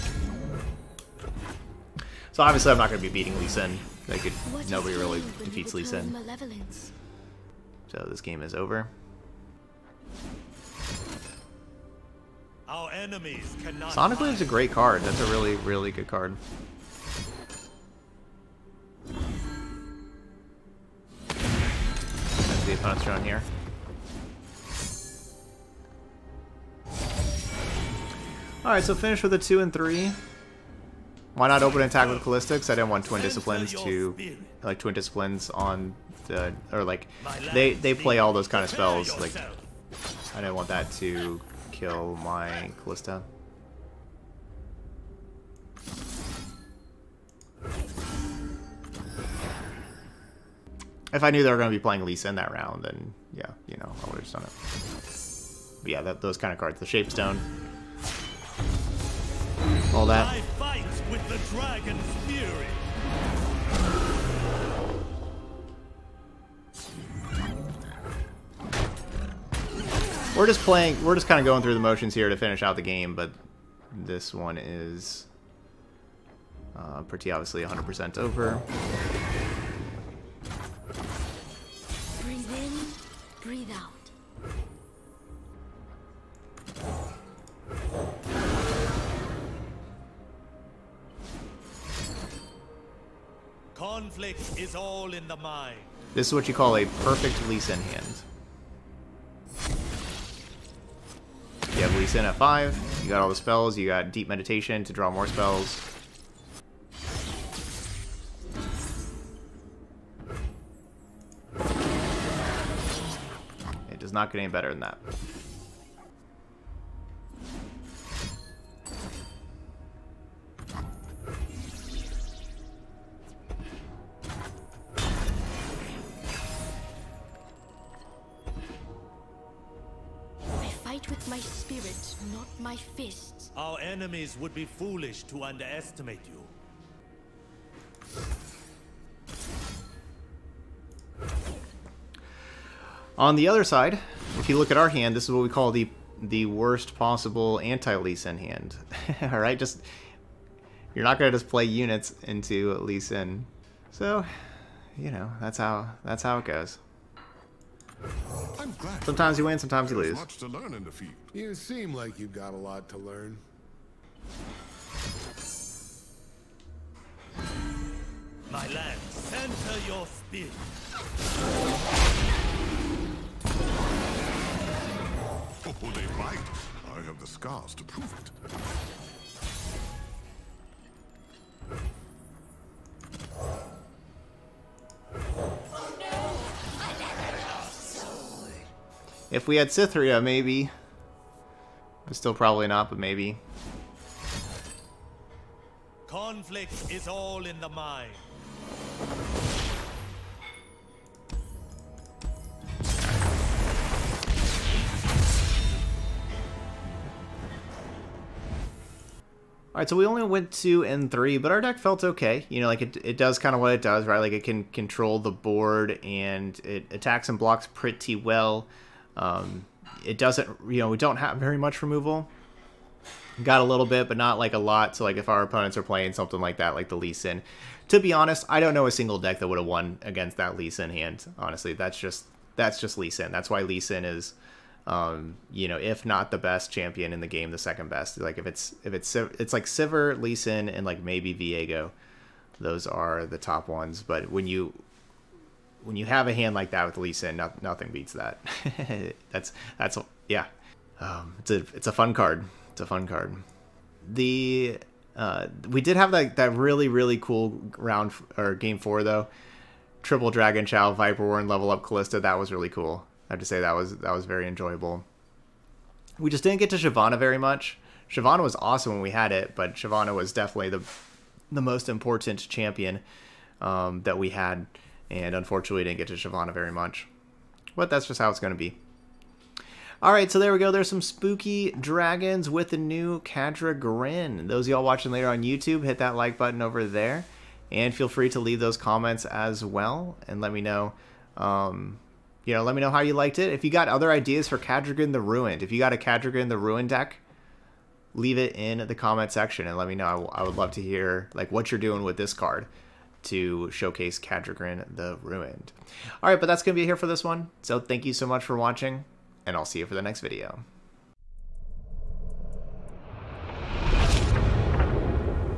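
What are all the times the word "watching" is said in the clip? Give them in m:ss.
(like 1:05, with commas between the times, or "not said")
4:44, 5:08.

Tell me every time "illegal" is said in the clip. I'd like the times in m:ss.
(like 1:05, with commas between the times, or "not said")
not said.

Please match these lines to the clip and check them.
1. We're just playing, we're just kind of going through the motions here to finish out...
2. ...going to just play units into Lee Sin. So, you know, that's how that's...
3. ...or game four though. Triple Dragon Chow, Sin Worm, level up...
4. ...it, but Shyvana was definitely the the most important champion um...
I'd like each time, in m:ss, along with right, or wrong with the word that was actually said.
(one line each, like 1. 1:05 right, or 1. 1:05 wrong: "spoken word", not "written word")
1. 1:10 right
2. 2:31 right
3. 4:18 wrong: "Viper", not "Sin"
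4. 4:29 right.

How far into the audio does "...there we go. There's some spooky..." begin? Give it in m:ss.
4:40.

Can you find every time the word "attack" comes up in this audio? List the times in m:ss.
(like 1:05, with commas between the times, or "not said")
0:31, 3:36.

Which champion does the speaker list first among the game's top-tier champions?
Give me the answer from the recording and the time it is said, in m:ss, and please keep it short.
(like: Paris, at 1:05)
Sivir, at 3:59.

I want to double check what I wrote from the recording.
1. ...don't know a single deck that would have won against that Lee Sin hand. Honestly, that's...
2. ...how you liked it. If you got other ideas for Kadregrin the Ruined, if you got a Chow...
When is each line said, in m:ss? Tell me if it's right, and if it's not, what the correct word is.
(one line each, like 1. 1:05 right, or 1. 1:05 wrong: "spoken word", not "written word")
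1. 3:48 right
2. 4:52 wrong: "Kadregrin", not "Chow".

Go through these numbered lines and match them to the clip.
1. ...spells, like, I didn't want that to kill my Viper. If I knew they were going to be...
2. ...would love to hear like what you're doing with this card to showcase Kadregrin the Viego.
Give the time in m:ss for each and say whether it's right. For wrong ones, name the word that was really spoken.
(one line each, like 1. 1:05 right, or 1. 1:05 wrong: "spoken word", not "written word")
1. 0:38 wrong: "Kalista", not "Viper"
2. 5:00 wrong: "Ruined", not "Viego".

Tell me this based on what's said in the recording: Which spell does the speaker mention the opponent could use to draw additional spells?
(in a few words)
Deep Meditation.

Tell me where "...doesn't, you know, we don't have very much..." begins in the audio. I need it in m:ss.
3:40.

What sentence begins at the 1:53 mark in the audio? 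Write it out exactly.
It does not get any better than that.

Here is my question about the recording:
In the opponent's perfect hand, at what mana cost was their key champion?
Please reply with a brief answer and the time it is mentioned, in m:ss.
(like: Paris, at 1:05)
5, at 1:42.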